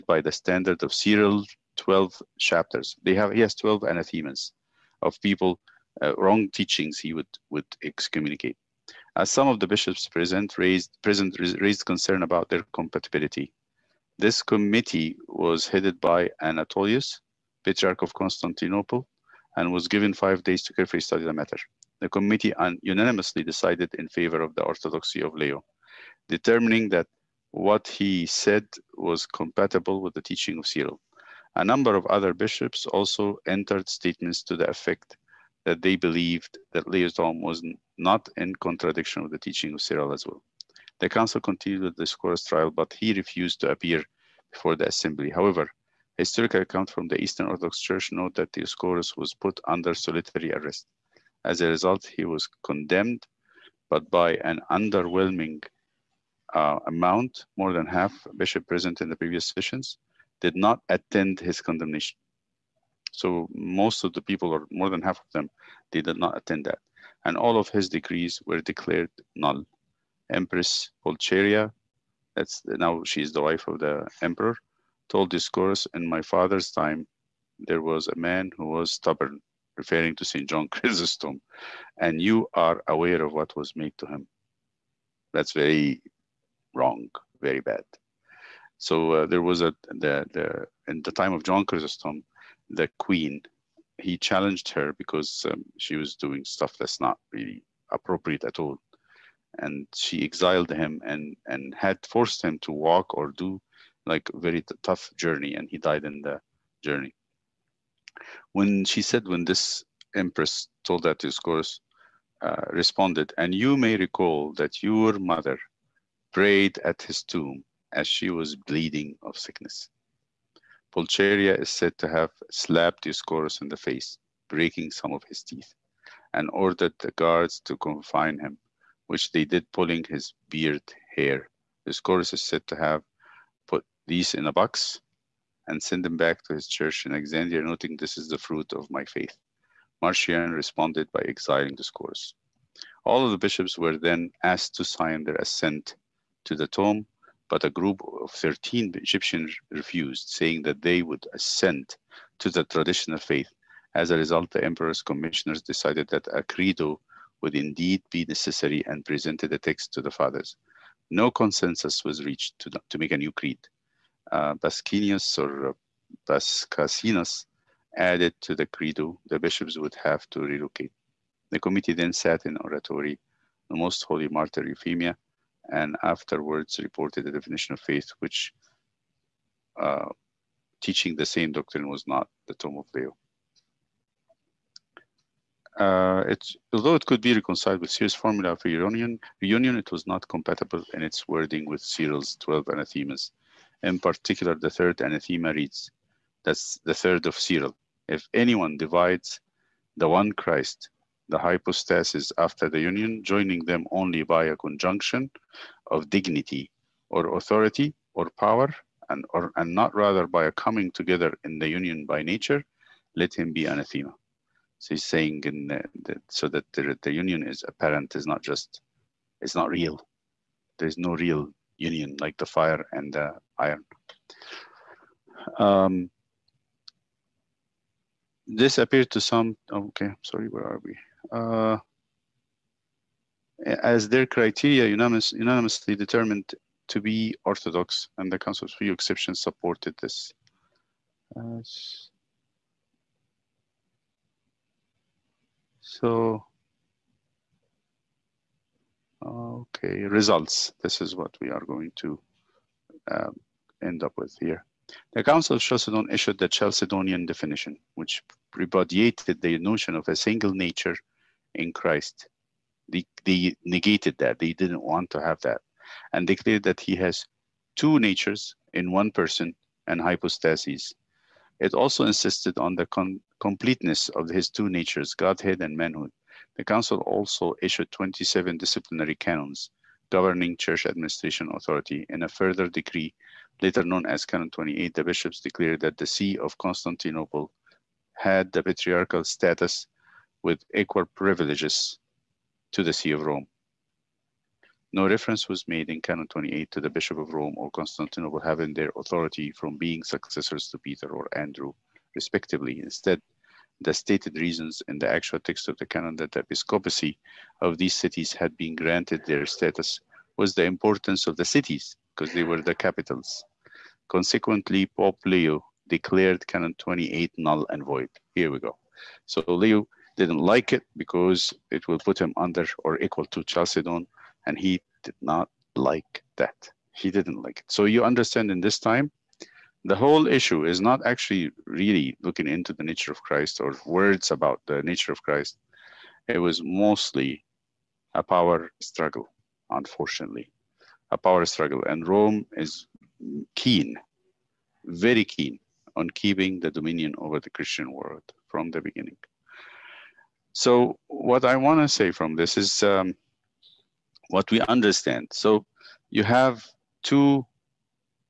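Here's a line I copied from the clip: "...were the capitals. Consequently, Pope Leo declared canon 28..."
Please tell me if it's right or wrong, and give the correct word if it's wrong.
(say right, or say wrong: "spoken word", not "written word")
right.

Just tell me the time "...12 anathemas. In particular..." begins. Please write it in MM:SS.
03:12.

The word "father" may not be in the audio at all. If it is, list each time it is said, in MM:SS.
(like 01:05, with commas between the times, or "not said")
01:16, 02:40.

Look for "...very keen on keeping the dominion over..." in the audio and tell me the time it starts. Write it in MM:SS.
05:44.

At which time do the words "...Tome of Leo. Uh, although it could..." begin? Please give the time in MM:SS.
03:02.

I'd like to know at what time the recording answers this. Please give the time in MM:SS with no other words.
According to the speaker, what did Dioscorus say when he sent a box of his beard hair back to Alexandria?
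02:17.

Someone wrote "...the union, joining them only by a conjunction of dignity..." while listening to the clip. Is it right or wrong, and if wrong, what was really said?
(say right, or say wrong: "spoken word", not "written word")
right.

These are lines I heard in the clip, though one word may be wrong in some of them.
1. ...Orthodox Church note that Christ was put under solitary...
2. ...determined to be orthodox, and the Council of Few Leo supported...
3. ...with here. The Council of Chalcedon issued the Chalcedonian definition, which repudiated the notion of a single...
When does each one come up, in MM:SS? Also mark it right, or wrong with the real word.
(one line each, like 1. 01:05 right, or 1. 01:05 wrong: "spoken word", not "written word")
1. 00:47 wrong: "Dioscorus", not "Christ"
2. 03:55 wrong: "Exceptions", not "Leo"
3. 04:14 right.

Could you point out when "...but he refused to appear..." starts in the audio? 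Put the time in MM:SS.
00:42.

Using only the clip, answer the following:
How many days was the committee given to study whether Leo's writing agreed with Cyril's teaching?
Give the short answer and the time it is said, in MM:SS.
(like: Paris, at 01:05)
5, at 00:20.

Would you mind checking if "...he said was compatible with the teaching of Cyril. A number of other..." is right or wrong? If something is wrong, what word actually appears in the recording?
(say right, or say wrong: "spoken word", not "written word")
right.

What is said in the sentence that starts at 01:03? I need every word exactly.
So most of the people, or more than half of them, they did not attend that.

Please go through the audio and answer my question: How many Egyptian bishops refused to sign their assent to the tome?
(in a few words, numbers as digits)
13.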